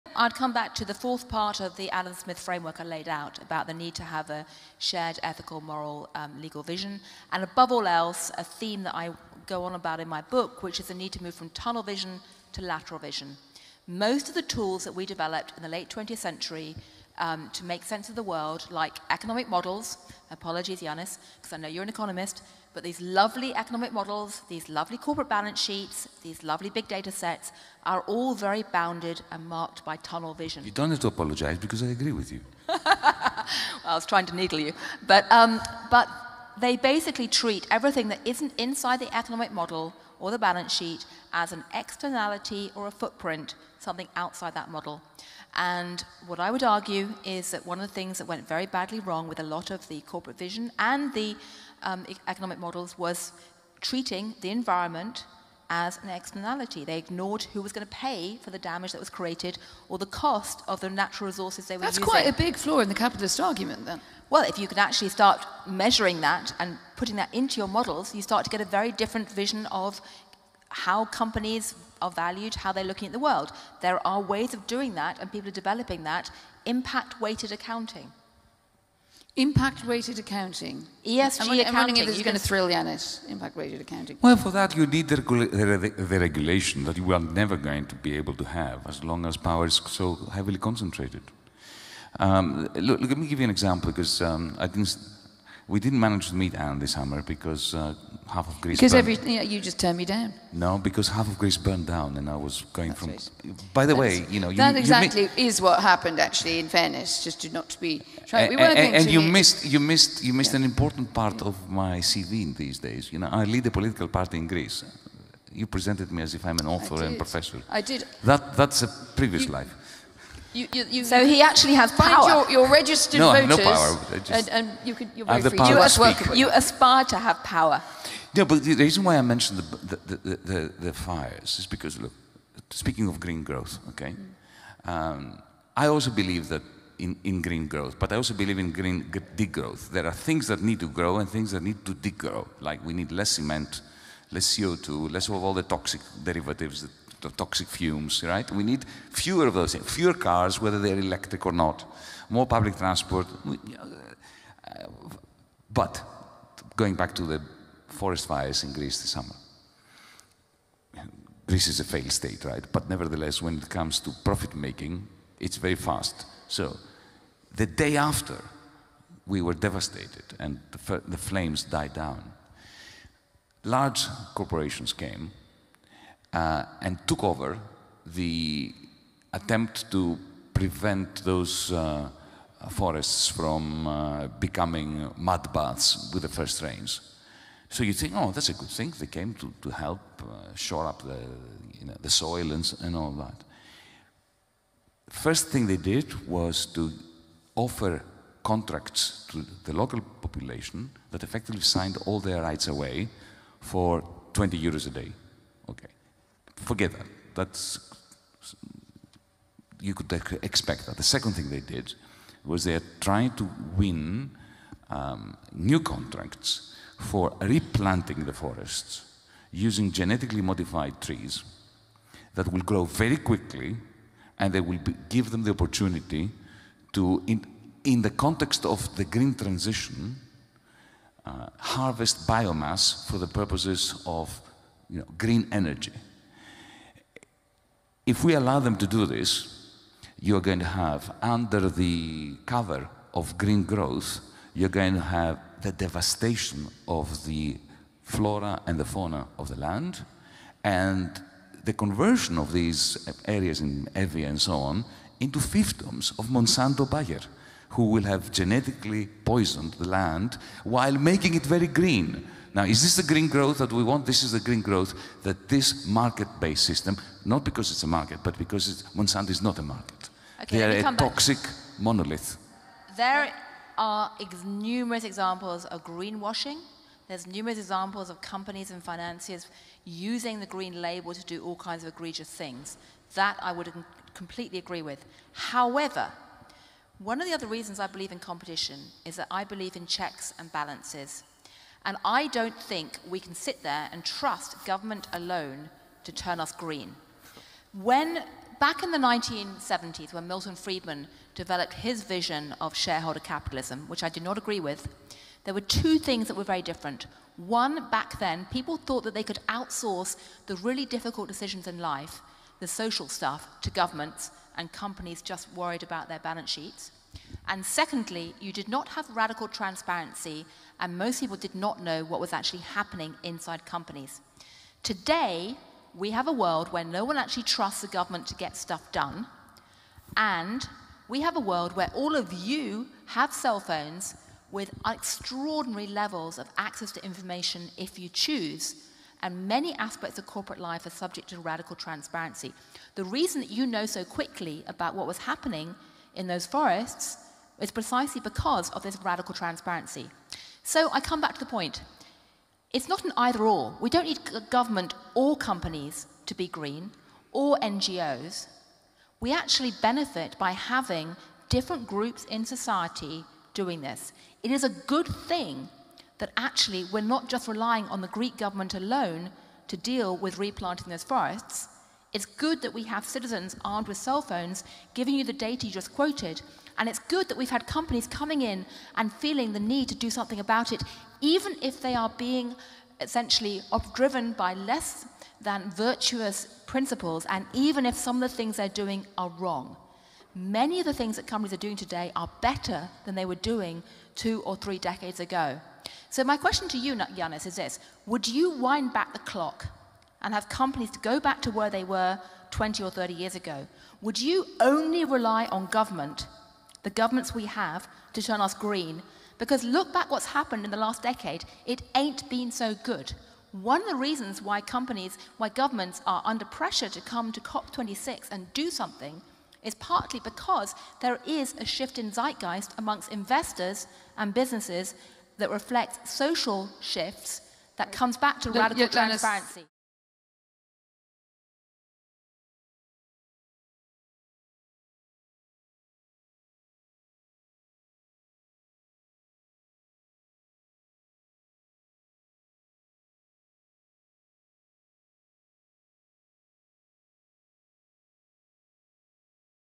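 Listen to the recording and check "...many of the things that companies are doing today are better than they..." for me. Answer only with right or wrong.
right.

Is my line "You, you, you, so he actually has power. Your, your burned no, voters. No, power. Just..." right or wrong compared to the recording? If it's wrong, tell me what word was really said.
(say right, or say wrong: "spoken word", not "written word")
wrong: "registered", not "burned".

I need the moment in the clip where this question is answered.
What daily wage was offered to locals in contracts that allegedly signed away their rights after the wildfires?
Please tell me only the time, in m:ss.
3:24.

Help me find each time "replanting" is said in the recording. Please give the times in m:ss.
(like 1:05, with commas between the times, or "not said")
3:37, 6:10.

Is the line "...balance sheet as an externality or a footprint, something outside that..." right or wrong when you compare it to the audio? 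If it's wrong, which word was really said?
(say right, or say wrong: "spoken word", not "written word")
right.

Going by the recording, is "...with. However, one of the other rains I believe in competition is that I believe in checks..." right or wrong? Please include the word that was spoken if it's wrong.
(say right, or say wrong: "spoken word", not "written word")
wrong: "reasons", not "rains".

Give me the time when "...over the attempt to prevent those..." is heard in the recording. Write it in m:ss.
2:57.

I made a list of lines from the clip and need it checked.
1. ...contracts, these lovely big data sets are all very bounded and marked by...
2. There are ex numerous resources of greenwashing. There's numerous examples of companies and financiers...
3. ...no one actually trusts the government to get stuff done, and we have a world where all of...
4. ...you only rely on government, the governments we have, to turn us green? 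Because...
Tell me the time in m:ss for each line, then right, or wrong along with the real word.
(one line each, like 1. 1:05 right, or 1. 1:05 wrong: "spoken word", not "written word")
1. 0:25 wrong: "sheets", not "contracts"
2. 4:32 wrong: "examples", not "resources"
3. 5:26 right
4. 6:44 right.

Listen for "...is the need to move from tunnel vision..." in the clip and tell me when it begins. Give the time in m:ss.
0:10.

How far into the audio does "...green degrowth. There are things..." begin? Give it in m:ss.
2:18.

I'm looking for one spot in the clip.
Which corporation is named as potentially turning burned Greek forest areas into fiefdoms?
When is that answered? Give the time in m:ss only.
4:16.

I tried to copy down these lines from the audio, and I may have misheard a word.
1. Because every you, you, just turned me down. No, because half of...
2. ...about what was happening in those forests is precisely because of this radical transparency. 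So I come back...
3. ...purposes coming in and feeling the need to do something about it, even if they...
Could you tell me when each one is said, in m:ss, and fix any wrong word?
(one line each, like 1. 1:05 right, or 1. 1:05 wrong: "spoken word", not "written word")
1. 1:38 right
2. 5:44 right
3. 6:17 wrong: "companies", not "purposes".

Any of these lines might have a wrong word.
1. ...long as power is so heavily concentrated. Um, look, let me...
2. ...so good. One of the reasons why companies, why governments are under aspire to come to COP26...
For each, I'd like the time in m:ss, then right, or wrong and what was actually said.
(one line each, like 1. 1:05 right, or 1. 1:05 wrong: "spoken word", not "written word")
1. 1:29 right
2. 6:52 wrong: "pressure", not "aspire".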